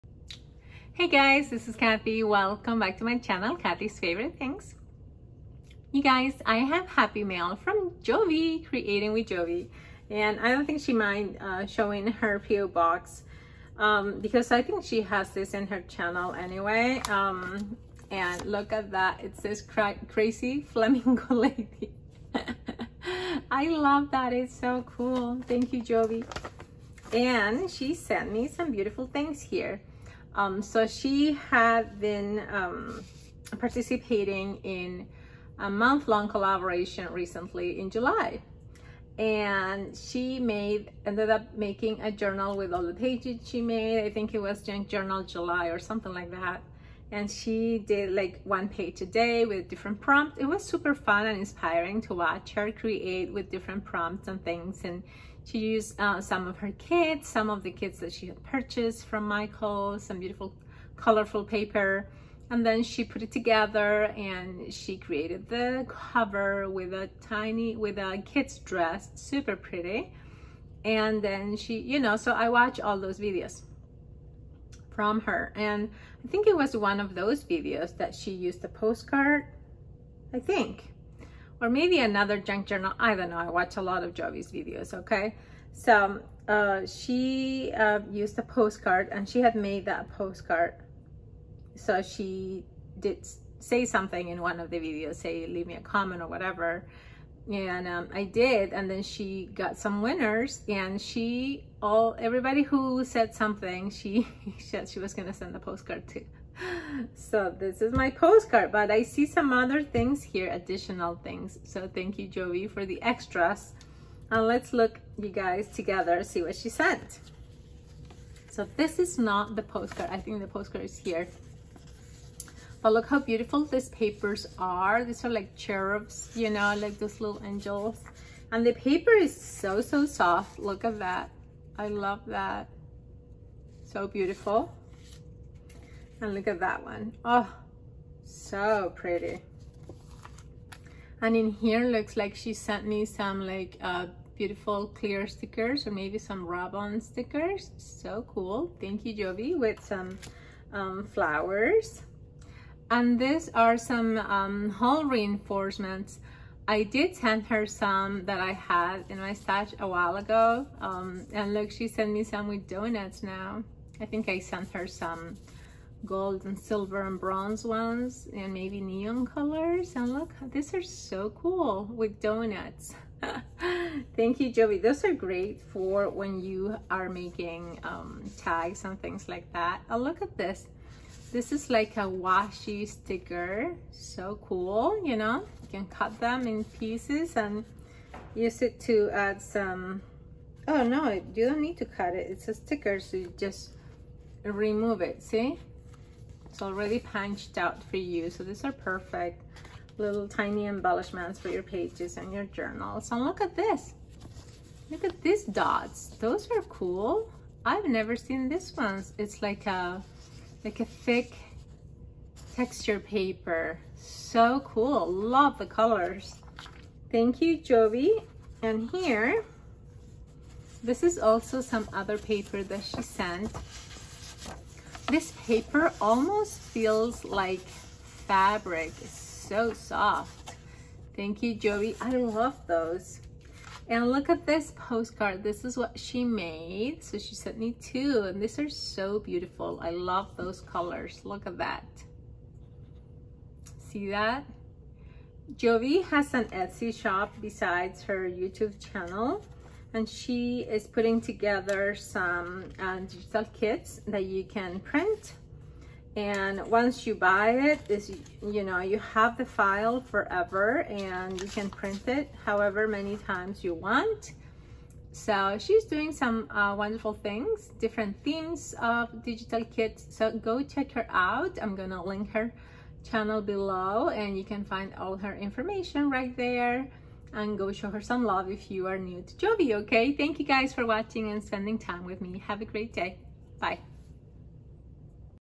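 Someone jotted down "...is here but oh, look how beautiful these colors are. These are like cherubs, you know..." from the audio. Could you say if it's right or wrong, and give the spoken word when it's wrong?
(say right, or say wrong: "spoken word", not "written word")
wrong: "papers", not "colors".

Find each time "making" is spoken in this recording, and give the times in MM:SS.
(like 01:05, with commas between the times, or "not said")
00:41, 02:57.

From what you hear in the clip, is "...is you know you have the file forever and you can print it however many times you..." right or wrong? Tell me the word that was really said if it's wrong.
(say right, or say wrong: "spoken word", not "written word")
right.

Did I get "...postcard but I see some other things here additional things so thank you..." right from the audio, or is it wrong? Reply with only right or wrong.
right.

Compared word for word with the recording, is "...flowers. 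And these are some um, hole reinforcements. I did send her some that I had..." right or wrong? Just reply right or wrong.
right.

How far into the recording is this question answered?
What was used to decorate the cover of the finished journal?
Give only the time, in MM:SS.
01:07.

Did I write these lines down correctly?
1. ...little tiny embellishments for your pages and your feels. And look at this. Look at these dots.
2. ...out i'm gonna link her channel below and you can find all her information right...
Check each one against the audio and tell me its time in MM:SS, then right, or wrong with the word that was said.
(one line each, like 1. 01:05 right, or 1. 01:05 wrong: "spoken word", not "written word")
1. 03:19 wrong: "journals", not "feels"
2. 04:31 right.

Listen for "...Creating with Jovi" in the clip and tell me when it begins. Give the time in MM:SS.
00:08.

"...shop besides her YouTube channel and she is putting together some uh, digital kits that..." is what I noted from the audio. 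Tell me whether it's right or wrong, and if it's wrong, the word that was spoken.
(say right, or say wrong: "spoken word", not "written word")
right.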